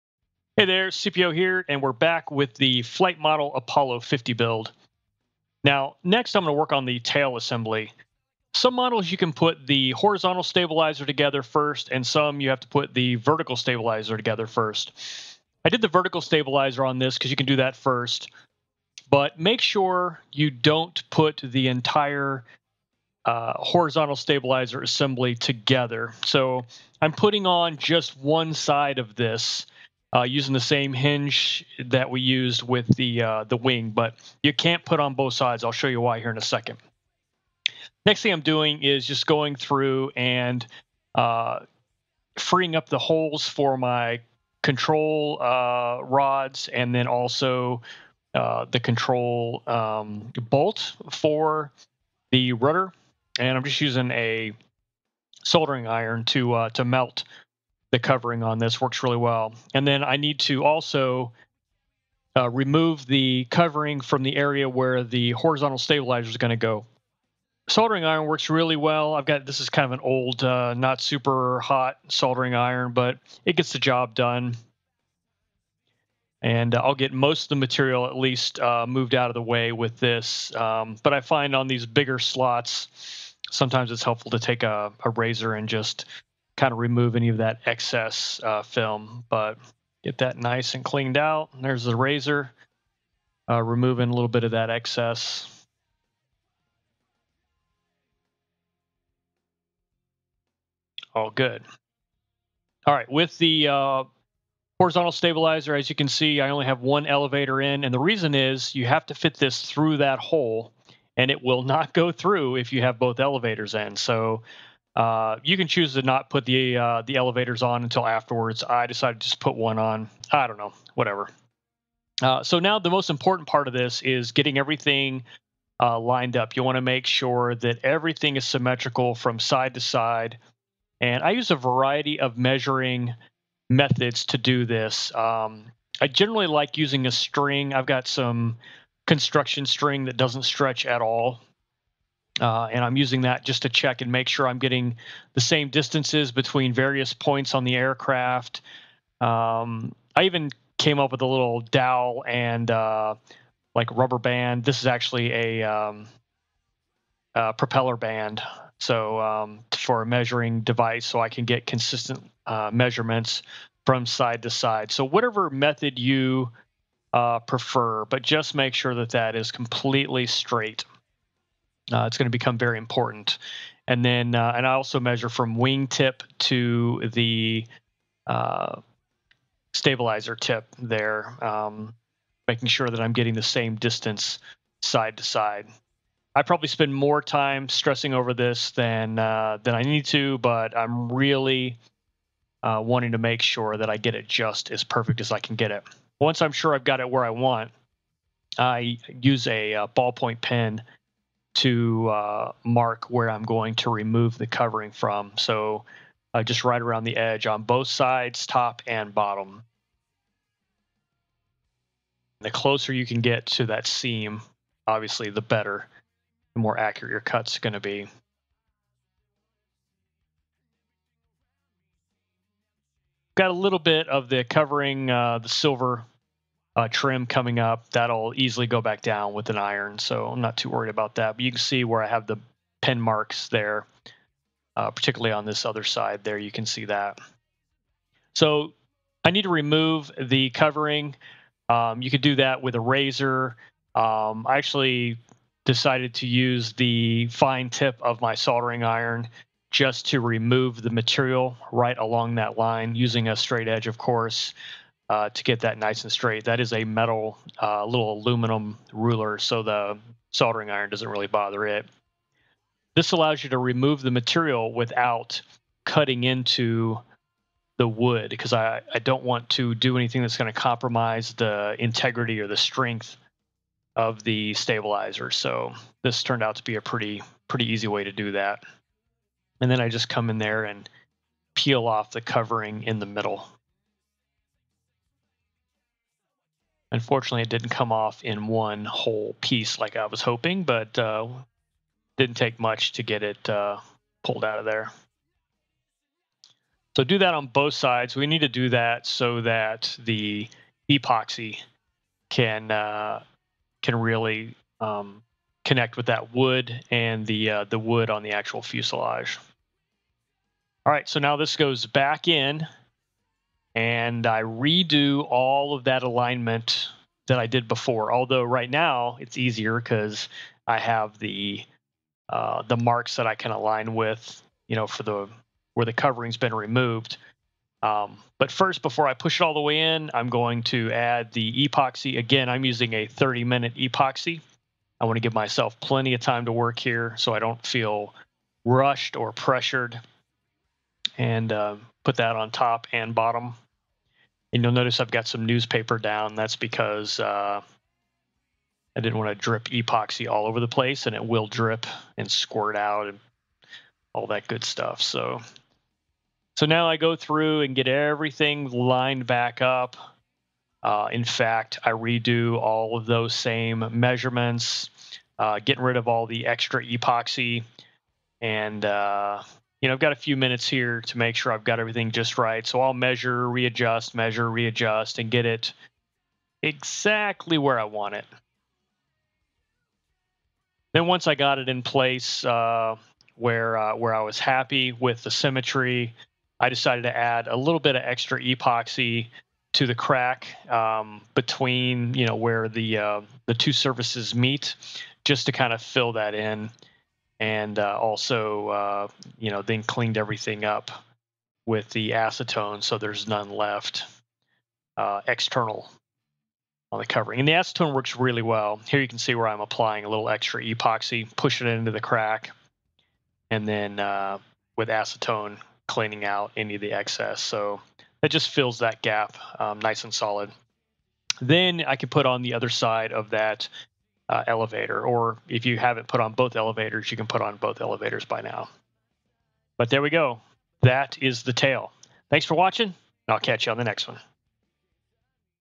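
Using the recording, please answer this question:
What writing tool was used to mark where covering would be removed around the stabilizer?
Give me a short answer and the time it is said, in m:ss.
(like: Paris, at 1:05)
ballpoint pen, at 3:19.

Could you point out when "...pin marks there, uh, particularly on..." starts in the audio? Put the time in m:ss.
3:52.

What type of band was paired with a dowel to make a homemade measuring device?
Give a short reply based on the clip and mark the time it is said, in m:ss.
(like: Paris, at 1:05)
propeller band, at 2:37.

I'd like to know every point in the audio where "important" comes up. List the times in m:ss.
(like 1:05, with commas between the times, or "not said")
2:03, 2:52.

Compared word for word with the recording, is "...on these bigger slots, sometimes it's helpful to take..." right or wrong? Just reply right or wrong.
right.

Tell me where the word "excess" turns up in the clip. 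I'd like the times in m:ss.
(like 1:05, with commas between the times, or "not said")
1:27, 1:34, 6:56.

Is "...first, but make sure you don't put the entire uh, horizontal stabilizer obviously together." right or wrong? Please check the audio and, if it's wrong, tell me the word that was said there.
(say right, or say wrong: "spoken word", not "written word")
wrong: "assembly", not "obviously".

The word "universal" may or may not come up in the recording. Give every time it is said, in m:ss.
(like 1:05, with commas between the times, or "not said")
not said.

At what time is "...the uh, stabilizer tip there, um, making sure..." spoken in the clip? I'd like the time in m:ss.
2:57.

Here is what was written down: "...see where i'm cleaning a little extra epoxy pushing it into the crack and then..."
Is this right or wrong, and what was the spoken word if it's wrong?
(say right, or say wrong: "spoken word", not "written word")
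wrong: "applying", not "cleaning".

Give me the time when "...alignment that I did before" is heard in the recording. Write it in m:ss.
5:16.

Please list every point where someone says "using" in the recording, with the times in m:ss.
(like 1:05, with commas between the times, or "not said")
0:30, 0:53, 2:16, 2:22, 4:12, 5:32.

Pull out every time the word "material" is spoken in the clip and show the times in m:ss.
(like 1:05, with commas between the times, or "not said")
1:17, 4:10, 4:24.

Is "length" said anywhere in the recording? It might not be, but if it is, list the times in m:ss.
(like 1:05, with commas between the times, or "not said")
not said.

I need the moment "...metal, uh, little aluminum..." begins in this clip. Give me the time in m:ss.
4:16.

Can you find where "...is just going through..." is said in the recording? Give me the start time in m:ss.
0:38.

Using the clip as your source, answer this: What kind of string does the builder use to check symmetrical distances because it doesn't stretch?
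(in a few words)
construction string.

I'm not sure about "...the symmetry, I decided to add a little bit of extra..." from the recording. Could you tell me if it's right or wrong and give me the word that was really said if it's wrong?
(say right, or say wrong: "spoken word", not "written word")
right.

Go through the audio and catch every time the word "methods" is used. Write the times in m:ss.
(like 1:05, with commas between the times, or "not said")
2:13, 2:45.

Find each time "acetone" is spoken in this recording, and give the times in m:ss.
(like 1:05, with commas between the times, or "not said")
6:42, 6:47, 6:54.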